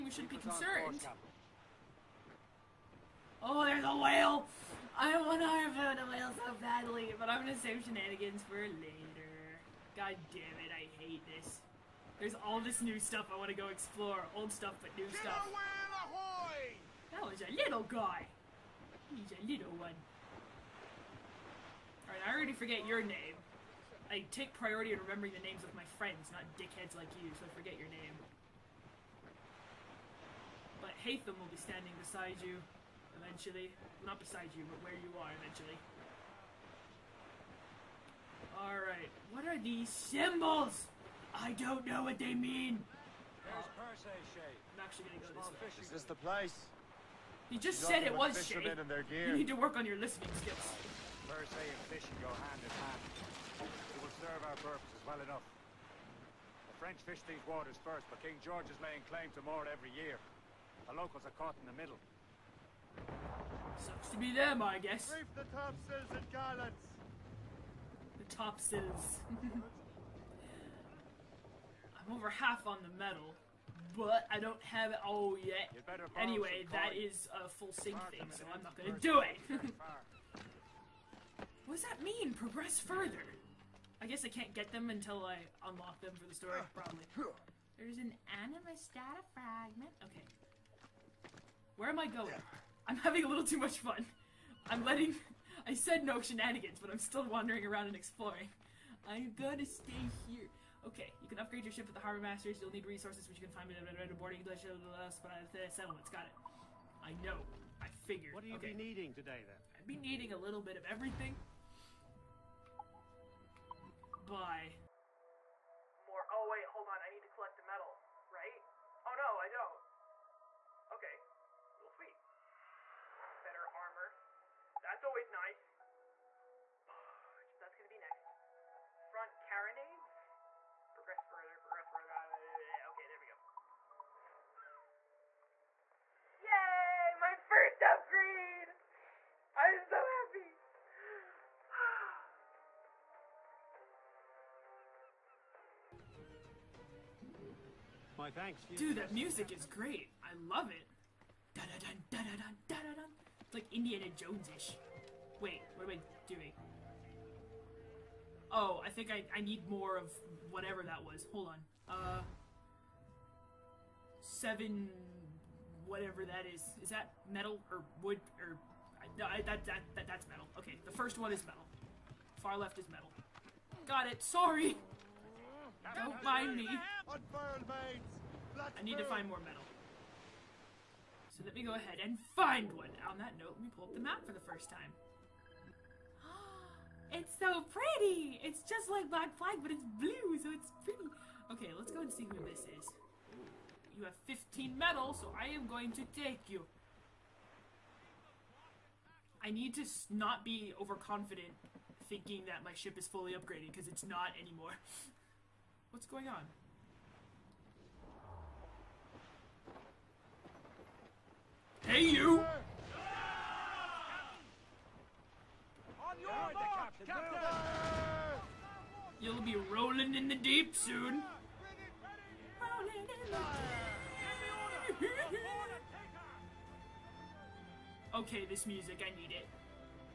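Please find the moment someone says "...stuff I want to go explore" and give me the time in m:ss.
0:12.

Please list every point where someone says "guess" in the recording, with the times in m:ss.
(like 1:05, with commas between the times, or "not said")
1:04, 1:24.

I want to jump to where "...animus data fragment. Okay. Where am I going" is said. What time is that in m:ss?
1:28.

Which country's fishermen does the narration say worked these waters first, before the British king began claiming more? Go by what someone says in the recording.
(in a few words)
The French.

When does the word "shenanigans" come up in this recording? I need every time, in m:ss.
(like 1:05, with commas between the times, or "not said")
0:07, 1:36.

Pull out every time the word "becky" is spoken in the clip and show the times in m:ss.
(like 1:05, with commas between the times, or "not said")
not said.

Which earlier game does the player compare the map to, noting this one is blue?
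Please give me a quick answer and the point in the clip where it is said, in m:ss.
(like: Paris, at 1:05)
Black Flag, at 3:09.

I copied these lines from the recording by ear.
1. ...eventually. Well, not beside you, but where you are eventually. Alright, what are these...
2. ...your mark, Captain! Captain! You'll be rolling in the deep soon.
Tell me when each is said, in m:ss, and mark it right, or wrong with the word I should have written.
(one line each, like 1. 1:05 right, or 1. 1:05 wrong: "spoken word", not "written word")
1. 0:33 right
2. 3:36 right.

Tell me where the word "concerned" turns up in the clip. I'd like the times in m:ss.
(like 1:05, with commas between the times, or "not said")
0:00.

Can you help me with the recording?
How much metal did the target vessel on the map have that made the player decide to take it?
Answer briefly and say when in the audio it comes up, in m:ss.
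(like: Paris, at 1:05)
15, at 3:14.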